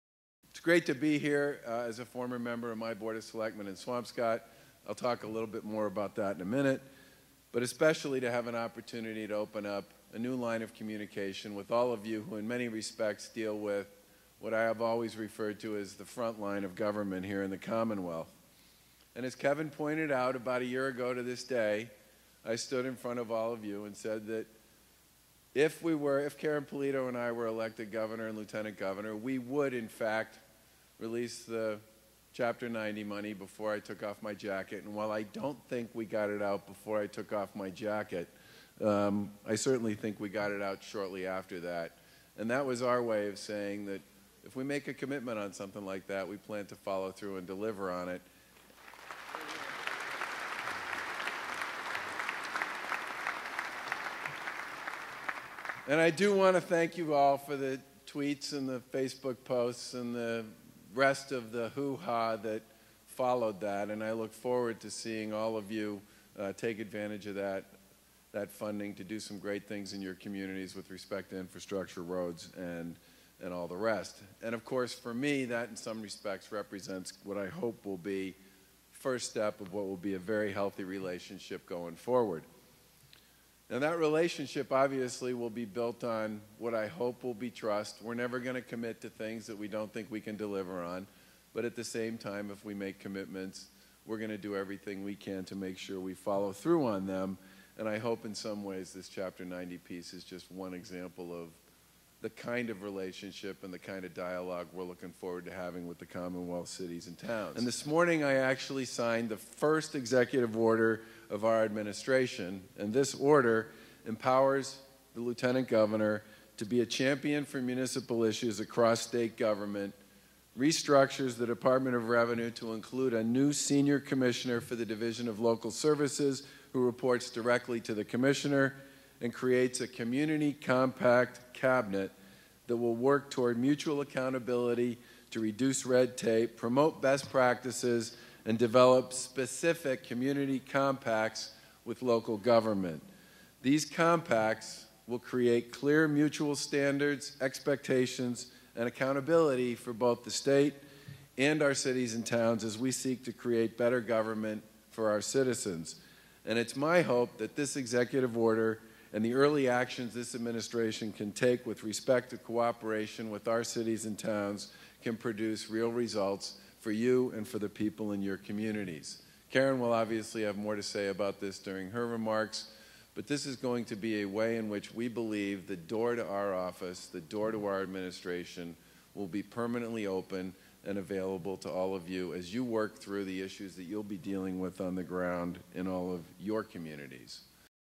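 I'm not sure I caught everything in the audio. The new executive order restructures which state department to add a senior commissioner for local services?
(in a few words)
Department of Revenue.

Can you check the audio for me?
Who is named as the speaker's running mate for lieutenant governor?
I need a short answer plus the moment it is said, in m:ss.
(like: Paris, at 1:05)
Karyn Polito, at 0:26.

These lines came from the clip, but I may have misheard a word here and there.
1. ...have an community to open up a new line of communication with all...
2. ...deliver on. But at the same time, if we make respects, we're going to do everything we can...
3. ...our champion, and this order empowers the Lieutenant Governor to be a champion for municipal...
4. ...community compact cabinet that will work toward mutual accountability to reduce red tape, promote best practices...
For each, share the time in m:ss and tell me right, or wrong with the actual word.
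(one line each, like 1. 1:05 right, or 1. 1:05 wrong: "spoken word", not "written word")
1. 0:08 wrong: "opportunity", not "community"
2. 1:30 wrong: "commitments", not "respects"
3. 1:51 wrong: "administration", not "champion"
4. 2:09 right.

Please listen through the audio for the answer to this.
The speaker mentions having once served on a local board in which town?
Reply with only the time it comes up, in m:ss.
0:03.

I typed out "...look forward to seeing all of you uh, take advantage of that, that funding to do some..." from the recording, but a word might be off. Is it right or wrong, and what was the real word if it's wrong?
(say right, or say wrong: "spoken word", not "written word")
right.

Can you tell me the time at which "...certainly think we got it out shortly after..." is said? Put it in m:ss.
0:39.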